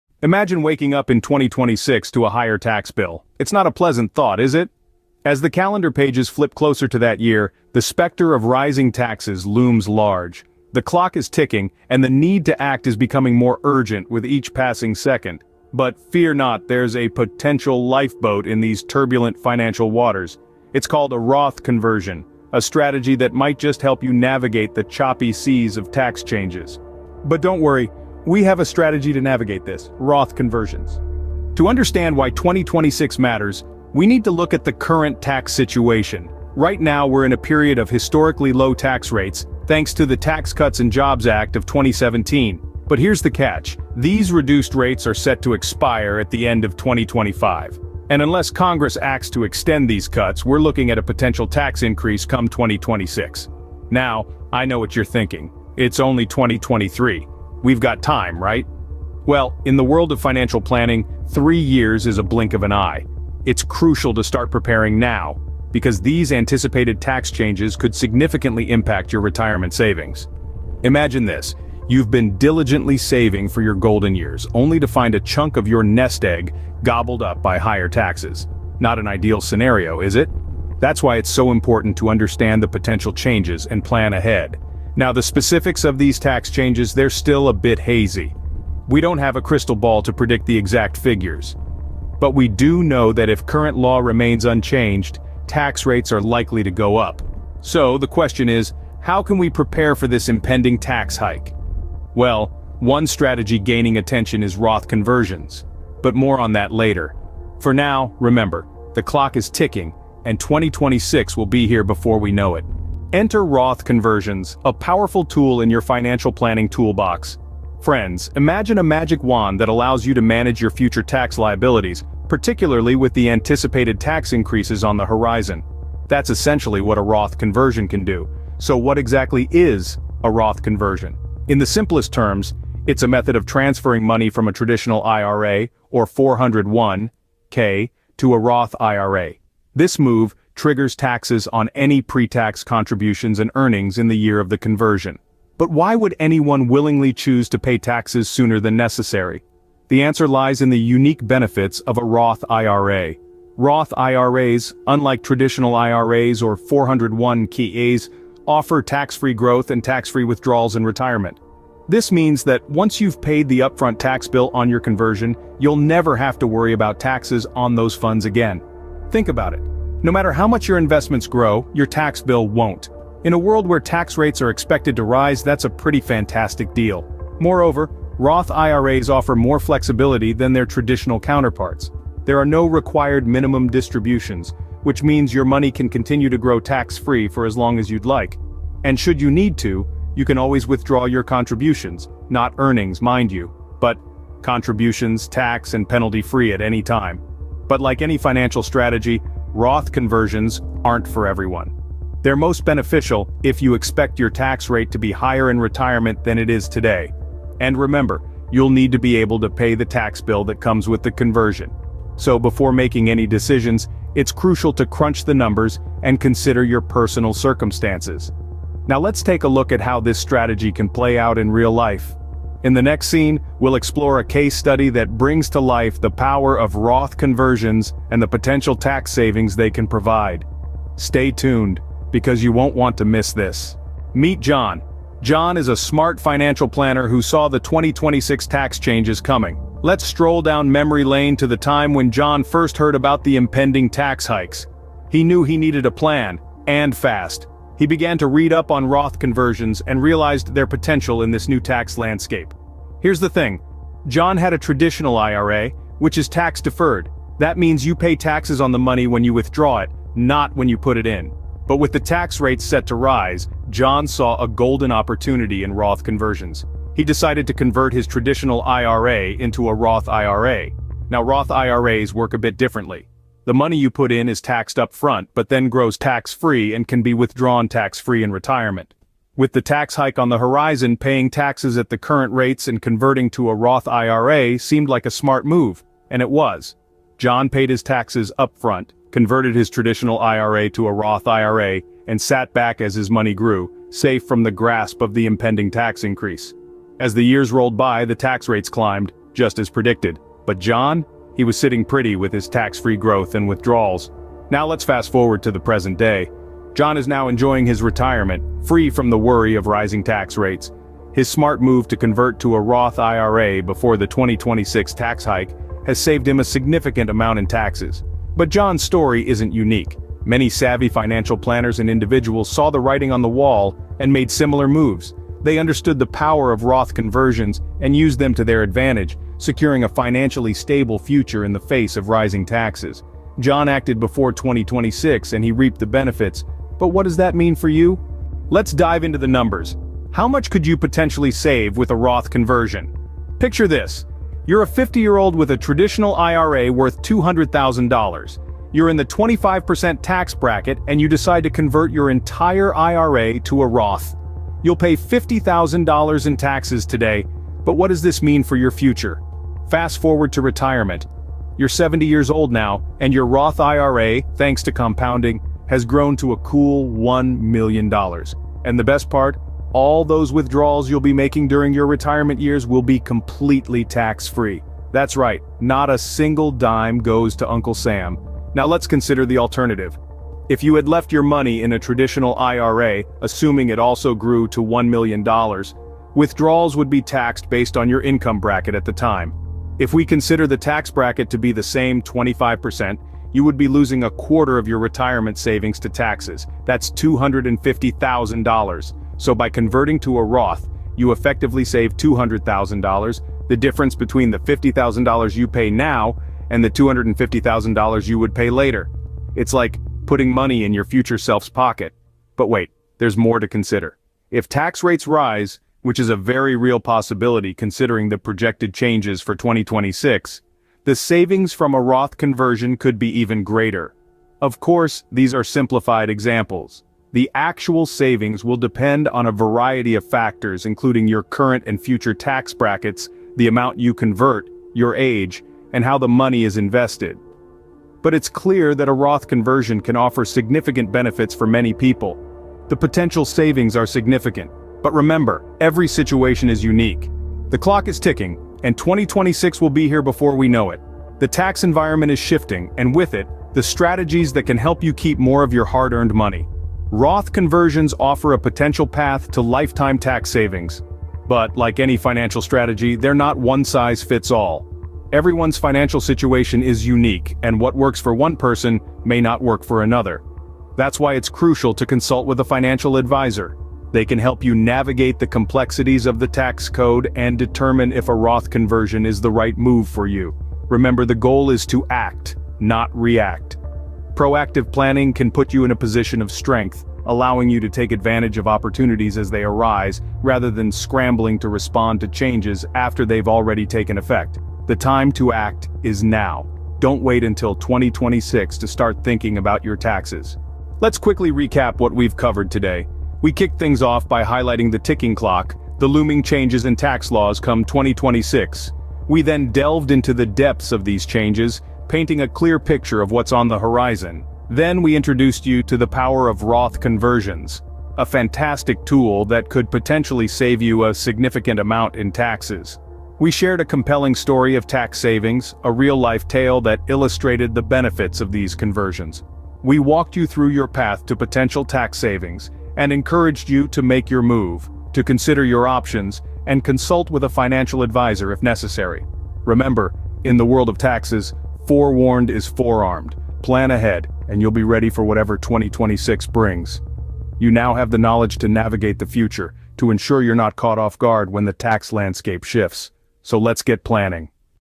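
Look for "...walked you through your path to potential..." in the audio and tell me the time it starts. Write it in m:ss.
8:49.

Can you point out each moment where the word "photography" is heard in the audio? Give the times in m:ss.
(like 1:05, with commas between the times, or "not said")
not said.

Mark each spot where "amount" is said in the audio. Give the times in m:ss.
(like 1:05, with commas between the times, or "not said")
5:17, 7:13, 8:41.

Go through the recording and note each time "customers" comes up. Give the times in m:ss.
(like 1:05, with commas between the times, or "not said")
not said.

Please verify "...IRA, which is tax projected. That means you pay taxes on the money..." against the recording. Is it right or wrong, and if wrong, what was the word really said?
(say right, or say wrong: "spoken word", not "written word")
wrong: "deferred", not "projected".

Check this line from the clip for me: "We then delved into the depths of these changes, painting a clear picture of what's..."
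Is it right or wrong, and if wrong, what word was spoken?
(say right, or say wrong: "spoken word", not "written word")
right.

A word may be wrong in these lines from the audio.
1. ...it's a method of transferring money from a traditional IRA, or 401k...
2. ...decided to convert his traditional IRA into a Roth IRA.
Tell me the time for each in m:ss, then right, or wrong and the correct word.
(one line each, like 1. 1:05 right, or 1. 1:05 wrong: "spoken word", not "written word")
1. 2:12 right
2. 4:27 right.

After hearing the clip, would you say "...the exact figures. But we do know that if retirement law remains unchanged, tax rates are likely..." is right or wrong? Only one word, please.
wrong.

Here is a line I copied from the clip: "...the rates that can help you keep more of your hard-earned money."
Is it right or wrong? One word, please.
wrong.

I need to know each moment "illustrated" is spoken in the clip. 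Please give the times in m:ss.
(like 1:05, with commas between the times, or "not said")
8:46.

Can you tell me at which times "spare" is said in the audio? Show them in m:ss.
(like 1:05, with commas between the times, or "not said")
not said.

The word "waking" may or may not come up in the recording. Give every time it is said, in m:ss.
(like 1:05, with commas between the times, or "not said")
0:00.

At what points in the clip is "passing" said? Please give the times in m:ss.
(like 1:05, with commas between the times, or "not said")
0:14.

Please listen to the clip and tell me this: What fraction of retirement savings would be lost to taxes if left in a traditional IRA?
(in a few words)
A quarter.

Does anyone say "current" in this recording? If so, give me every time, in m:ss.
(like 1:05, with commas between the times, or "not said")
0:34, 1:33, 4:41, 7:11.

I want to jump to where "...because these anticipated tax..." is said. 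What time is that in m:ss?
1:05.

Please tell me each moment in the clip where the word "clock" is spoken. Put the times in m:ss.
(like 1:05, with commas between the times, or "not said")
0:10, 1:49, 7:27, 8:25.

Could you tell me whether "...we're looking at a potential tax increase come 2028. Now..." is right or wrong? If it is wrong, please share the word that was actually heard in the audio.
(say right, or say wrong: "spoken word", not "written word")
wrong: "2026", not "2028".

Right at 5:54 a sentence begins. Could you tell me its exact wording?
You'll pay $50,000 in taxes today, but what does this mean for your future?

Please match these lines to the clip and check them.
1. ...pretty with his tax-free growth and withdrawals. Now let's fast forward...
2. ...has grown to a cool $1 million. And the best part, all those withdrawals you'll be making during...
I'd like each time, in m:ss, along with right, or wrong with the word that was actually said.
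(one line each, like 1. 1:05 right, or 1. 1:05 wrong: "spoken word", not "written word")
1. 5:01 right
2. 6:05 right.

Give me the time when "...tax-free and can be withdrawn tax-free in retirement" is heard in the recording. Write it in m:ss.
4:35.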